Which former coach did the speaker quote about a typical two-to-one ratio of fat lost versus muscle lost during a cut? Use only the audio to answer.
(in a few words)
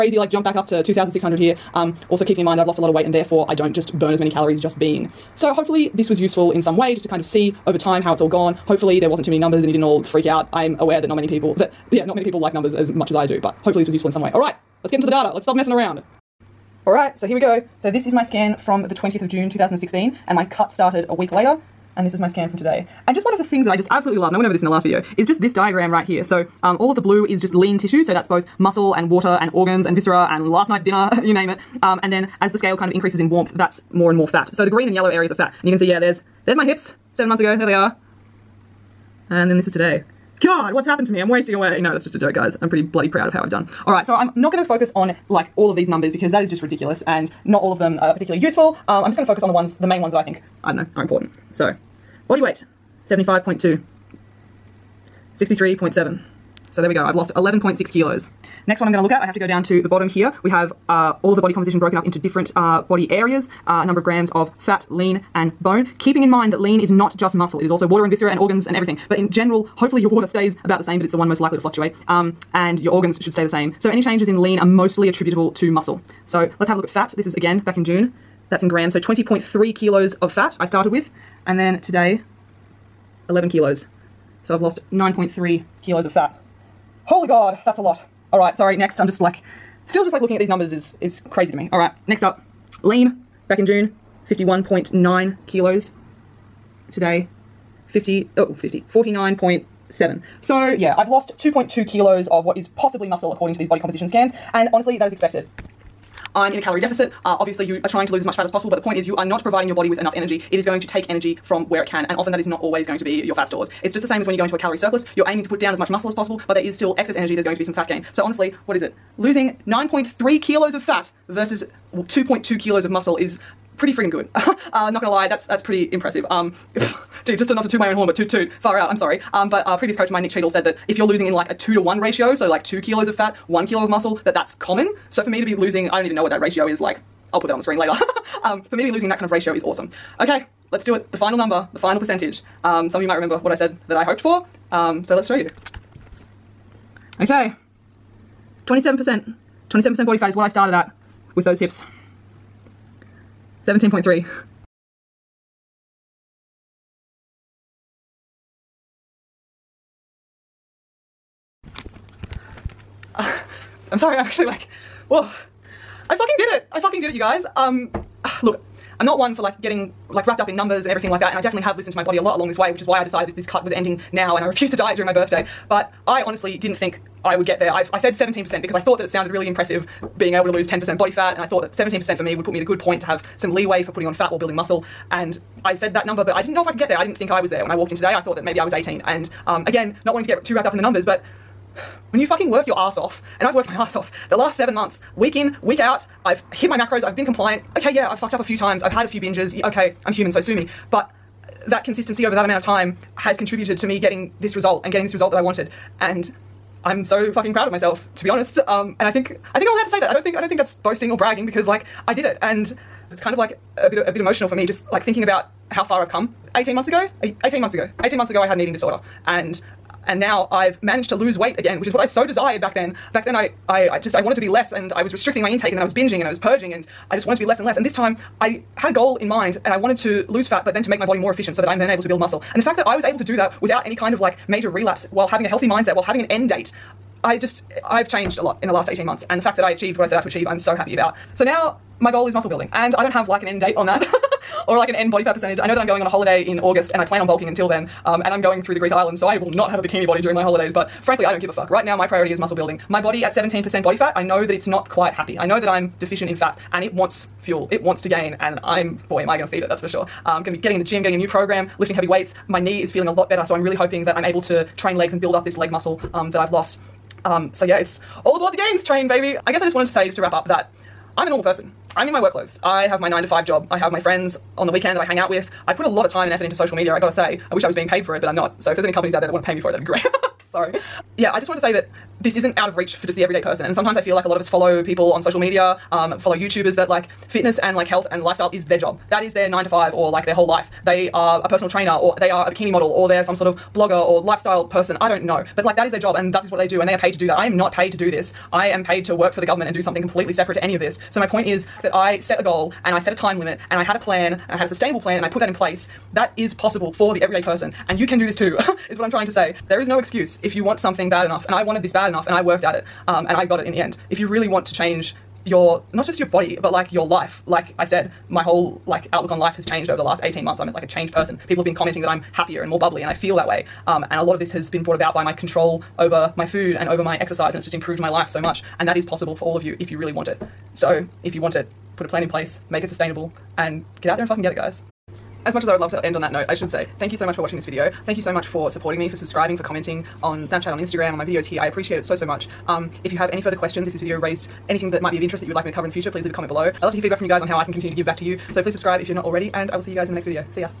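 Nick Cheadle.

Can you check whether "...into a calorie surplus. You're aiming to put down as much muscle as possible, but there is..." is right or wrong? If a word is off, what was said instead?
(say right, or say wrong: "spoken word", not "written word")
right.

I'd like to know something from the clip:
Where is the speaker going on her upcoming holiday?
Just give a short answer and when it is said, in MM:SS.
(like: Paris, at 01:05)
Greek islands, at 04:08.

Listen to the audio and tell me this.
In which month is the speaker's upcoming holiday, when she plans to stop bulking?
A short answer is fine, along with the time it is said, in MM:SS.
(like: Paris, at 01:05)
August, at 04:06.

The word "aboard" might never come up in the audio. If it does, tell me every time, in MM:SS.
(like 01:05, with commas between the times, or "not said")
04:28.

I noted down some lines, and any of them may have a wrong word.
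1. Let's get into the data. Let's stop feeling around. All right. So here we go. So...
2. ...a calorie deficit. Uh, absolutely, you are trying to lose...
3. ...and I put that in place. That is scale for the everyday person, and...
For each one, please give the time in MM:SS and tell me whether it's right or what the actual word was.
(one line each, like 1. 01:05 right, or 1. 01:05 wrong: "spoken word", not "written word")
1. 00:14 wrong: "messing", not "feeling"
2. 01:46 wrong: "obviously", not "absolutely"
3. 05:05 wrong: "possible", not "scale".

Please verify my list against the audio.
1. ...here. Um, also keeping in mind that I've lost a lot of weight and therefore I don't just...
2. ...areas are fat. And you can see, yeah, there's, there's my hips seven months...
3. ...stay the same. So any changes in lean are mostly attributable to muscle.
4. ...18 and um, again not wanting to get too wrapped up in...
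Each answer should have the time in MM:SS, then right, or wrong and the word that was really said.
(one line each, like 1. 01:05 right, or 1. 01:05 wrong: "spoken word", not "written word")
1. 00:01 right
2. 00:35 right
3. 01:13 right
4. 03:08 right.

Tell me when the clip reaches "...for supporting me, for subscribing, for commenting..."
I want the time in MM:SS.
05:38.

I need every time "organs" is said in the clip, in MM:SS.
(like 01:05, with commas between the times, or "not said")
00:29, 01:08, 01:12.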